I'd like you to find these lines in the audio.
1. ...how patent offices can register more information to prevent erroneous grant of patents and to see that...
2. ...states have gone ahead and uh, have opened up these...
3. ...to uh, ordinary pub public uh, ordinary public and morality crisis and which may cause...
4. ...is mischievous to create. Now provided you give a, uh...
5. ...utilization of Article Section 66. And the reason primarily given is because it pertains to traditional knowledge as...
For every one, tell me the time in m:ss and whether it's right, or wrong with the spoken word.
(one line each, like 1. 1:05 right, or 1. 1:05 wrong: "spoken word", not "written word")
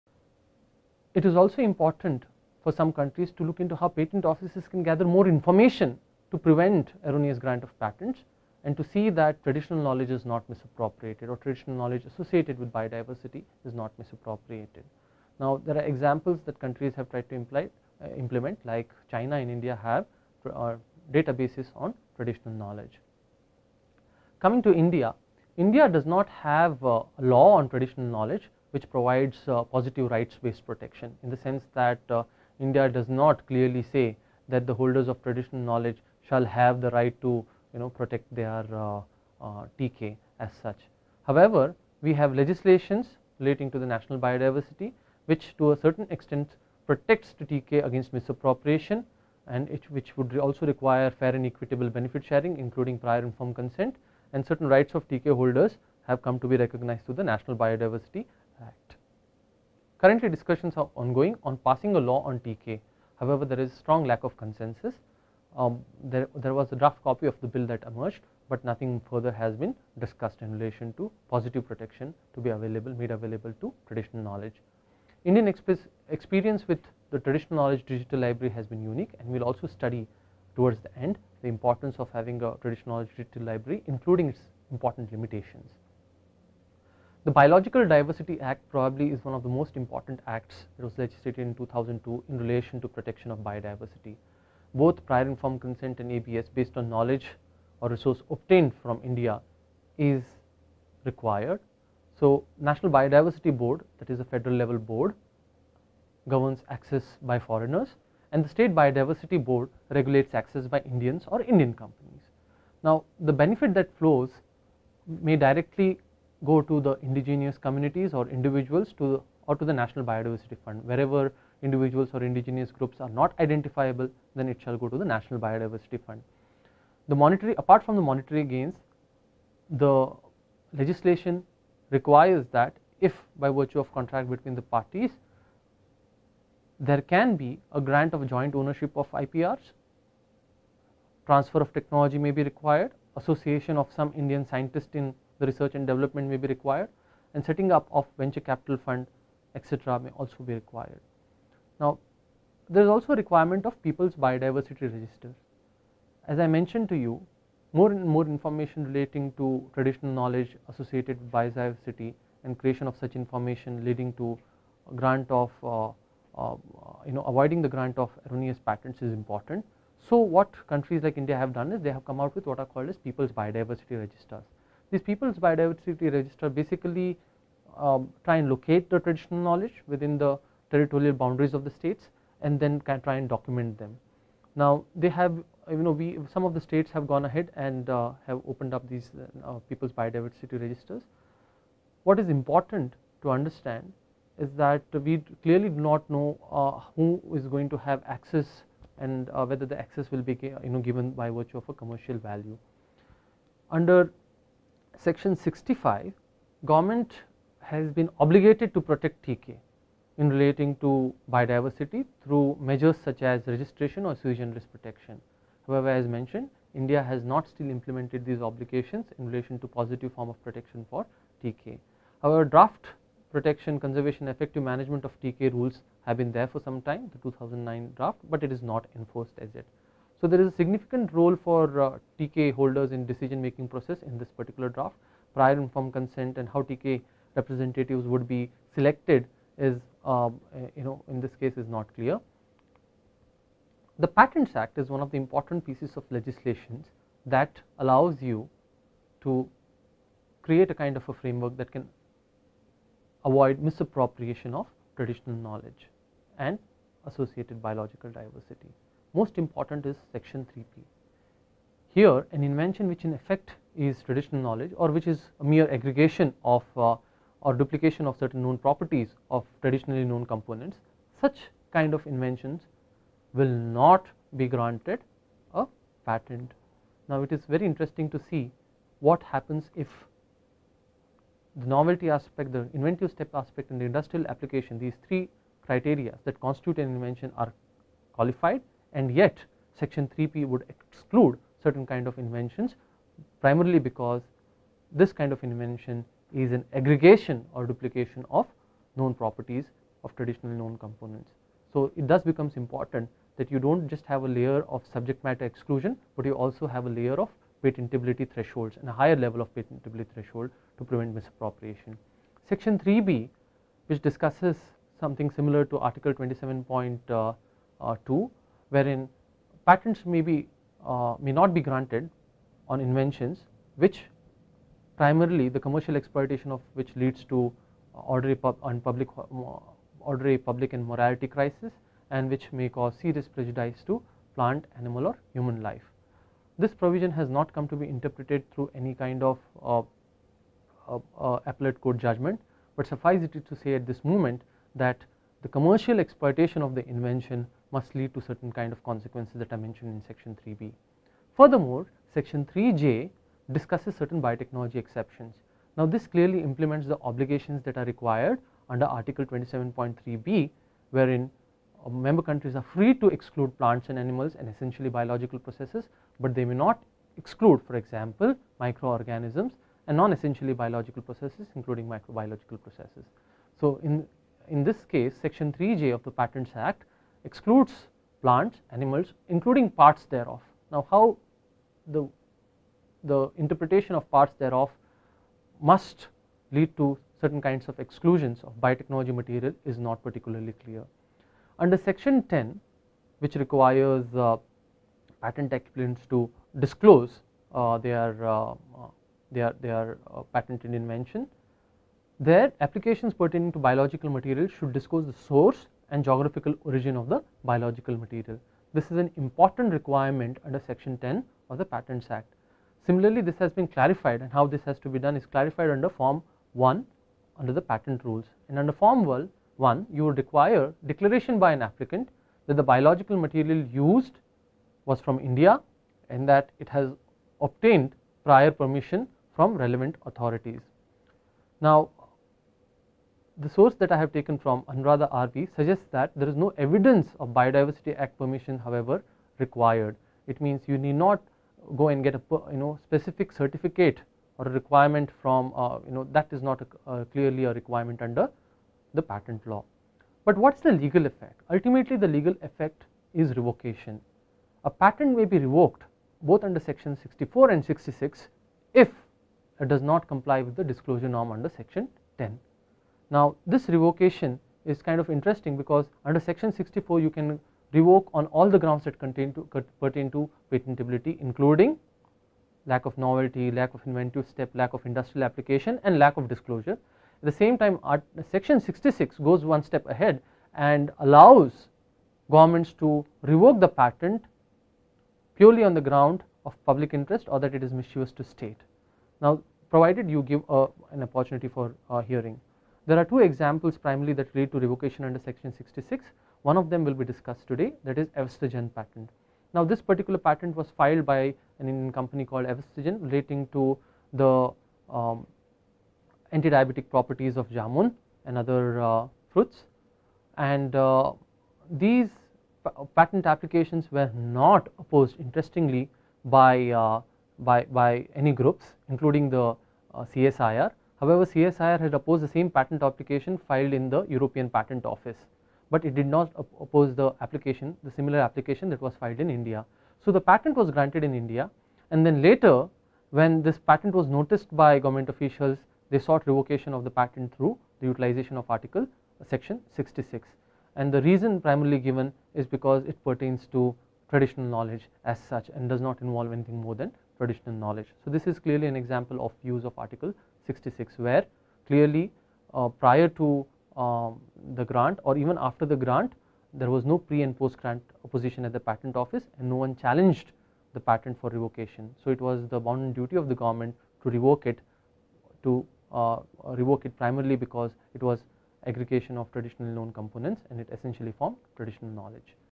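1. 0:03 wrong: "gather", not "register"
2. 3:06 right
3. 5:27 right
4. 8:07 wrong: "state", not "create"
5. 8:57 right.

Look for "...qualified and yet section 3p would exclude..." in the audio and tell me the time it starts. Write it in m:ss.
4:48.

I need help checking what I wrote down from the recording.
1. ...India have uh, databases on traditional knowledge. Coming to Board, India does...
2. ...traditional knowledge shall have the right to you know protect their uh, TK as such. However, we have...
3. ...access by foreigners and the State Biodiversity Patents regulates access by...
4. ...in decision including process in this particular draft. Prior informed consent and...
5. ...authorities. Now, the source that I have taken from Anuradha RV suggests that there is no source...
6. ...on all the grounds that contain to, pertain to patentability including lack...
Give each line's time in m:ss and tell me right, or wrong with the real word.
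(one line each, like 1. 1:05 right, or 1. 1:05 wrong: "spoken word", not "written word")
1. 0:19 wrong: "India", not "Board"
2. 0:35 right
3. 1:46 wrong: "Board", not "Patents"
4. 3:52 wrong: "making", not "including"
5. 7:10 wrong: "evidence", not "source"
6. 7:48 right.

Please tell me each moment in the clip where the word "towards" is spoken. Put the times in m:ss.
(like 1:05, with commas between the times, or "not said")
1:20.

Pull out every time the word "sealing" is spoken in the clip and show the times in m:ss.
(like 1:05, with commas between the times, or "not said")
not said.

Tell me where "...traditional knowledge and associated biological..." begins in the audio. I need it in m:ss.
4:14.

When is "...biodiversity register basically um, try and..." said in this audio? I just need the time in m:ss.
2:55.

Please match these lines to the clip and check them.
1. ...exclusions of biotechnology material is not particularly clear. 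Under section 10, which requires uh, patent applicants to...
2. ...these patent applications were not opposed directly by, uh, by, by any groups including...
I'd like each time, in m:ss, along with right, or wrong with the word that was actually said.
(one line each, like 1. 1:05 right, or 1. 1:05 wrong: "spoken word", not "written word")
1. 6:27 right
2. 8:31 wrong: "interestingly", not "directly".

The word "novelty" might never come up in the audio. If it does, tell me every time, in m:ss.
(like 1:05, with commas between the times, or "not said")
4:41, 7:52.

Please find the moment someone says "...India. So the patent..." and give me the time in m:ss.
8:49.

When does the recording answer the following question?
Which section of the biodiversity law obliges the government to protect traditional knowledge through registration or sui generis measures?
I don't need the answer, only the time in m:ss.
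3:25.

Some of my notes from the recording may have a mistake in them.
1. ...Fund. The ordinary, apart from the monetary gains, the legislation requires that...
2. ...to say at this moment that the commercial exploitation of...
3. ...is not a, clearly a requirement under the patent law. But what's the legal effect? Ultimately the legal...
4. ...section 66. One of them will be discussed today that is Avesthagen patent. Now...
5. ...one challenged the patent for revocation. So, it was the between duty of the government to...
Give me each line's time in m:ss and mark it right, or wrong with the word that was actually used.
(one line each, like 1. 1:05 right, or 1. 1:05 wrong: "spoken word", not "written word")
1. 2:06 wrong: "monetary", not "ordinary"
2. 5:43 right
3. 7:26 right
4. 8:15 right
5. 9:19 wrong: "bounden", not "between".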